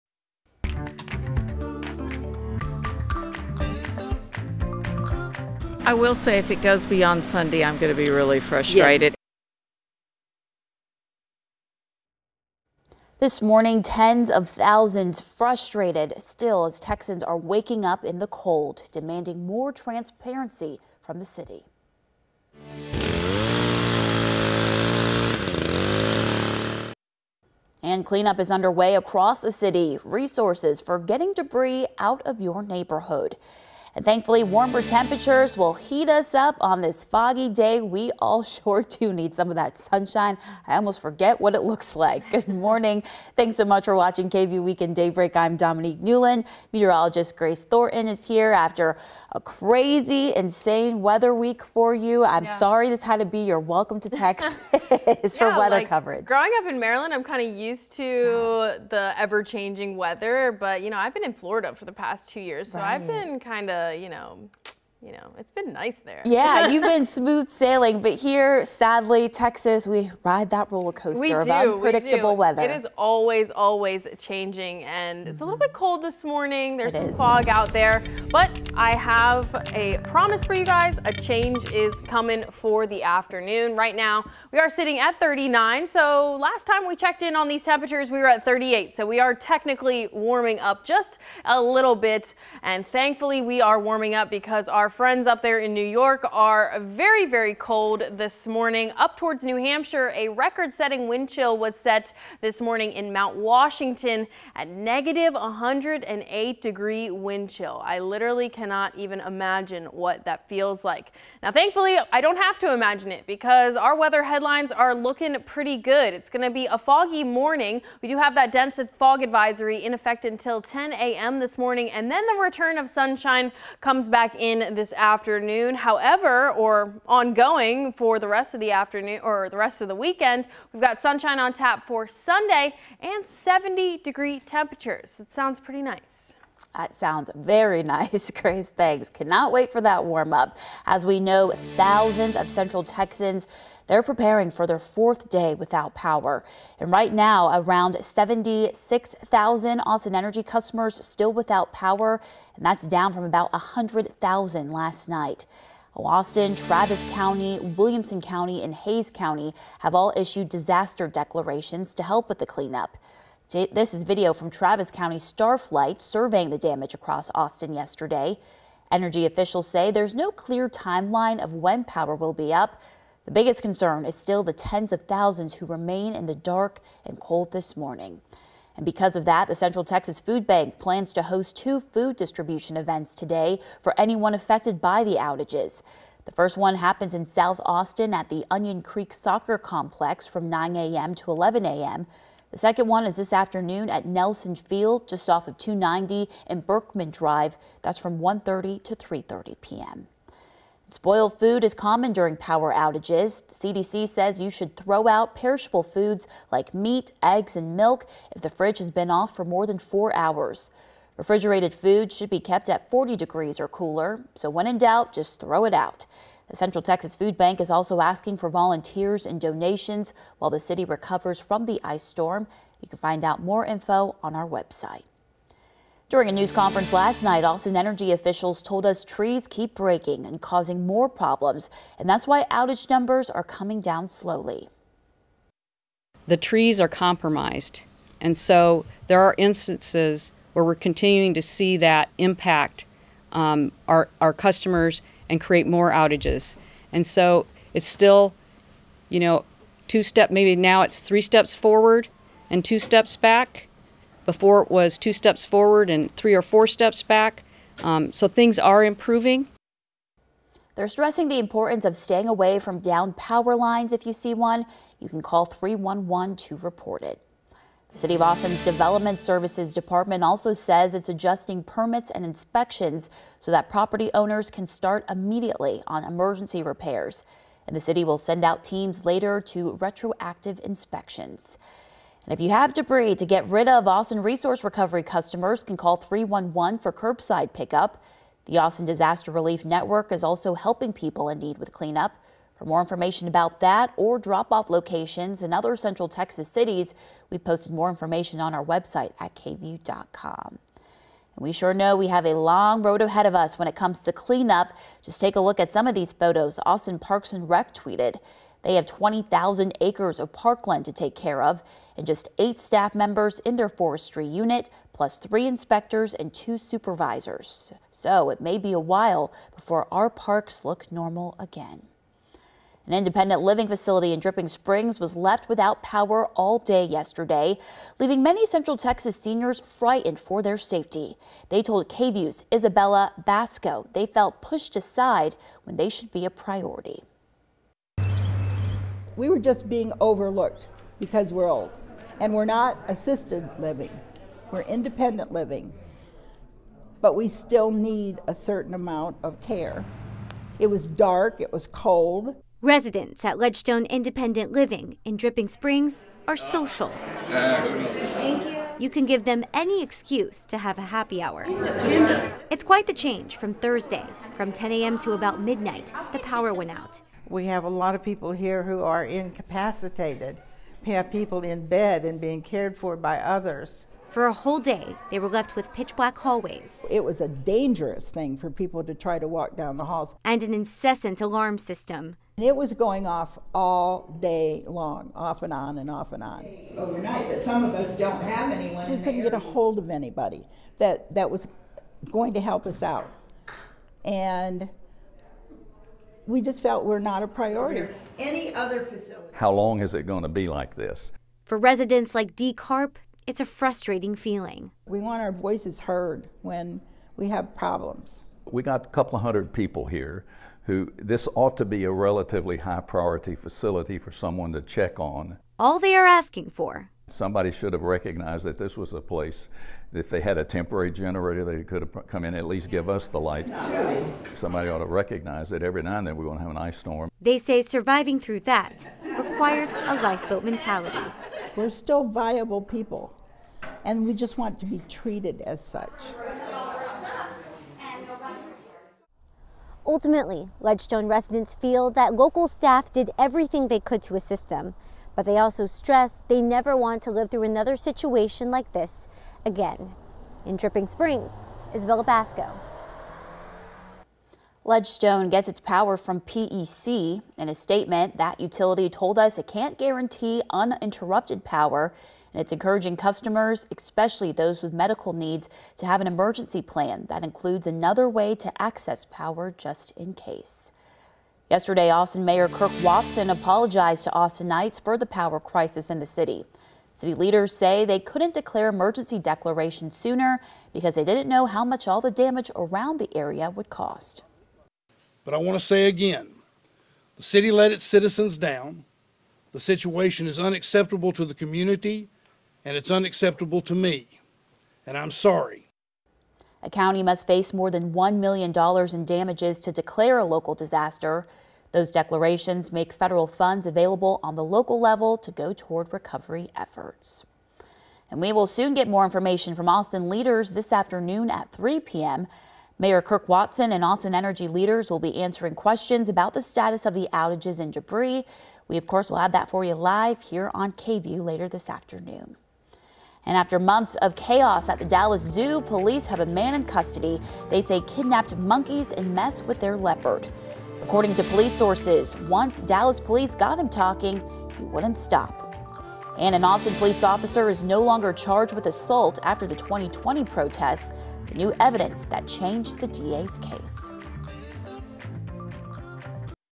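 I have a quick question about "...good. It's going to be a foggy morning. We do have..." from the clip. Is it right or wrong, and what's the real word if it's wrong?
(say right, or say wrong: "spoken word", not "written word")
right.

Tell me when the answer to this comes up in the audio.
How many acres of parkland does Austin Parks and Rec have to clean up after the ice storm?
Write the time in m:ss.
5:08.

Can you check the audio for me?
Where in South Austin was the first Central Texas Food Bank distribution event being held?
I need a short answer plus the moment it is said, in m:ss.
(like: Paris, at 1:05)
Onion Creek Soccer Complex, at 3:08.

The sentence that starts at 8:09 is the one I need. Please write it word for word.
The situation is unacceptable to the community, and it's unacceptable to me.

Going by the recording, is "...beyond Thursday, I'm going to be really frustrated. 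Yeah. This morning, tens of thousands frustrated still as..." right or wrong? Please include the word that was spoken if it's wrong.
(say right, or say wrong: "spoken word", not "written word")
wrong: "Sunday", not "Thursday".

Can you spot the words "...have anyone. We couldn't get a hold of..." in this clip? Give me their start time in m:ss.
6:28.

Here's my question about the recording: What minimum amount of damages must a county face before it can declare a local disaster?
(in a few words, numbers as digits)
$1 million.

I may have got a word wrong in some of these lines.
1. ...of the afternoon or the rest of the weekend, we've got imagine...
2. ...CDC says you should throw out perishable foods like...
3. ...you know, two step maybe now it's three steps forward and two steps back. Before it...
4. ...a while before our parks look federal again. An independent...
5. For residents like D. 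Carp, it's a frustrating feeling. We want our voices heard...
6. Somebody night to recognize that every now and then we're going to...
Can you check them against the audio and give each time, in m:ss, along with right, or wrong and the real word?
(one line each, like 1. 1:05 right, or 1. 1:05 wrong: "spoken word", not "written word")
1. 2:08 wrong: "sunshine", not "imagine"
2. 3:23 right
3. 4:09 right
4. 5:18 wrong: "normal", not "federal"
5. 6:41 right
6. 7:04 wrong: "ought", not "night".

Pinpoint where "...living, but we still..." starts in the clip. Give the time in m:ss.
5:45.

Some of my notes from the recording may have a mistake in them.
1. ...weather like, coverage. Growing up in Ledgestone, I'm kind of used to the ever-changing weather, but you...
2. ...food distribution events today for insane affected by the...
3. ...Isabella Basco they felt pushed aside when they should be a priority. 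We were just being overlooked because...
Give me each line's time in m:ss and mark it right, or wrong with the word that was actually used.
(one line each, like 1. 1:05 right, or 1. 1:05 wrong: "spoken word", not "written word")
1. 0:55 wrong: "Maryland", not "Ledgestone"
2. 3:01 wrong: "anyone", not "insane"
3. 5:32 right.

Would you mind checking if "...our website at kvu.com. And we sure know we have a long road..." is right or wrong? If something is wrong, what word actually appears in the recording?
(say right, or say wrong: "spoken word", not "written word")
right.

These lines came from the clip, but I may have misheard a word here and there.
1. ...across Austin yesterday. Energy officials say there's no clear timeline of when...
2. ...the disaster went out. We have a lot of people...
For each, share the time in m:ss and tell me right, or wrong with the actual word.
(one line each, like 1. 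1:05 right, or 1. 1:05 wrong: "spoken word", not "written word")
1. 2:46 right
2. 6:06 wrong: "power", not "disaster".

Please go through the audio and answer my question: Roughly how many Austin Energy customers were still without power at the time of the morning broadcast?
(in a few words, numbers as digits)
76,000.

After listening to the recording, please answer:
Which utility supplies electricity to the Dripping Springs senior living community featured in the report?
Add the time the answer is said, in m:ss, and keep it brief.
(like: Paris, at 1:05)
PEC, at 7:36.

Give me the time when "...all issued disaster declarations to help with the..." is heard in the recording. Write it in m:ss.
2:39.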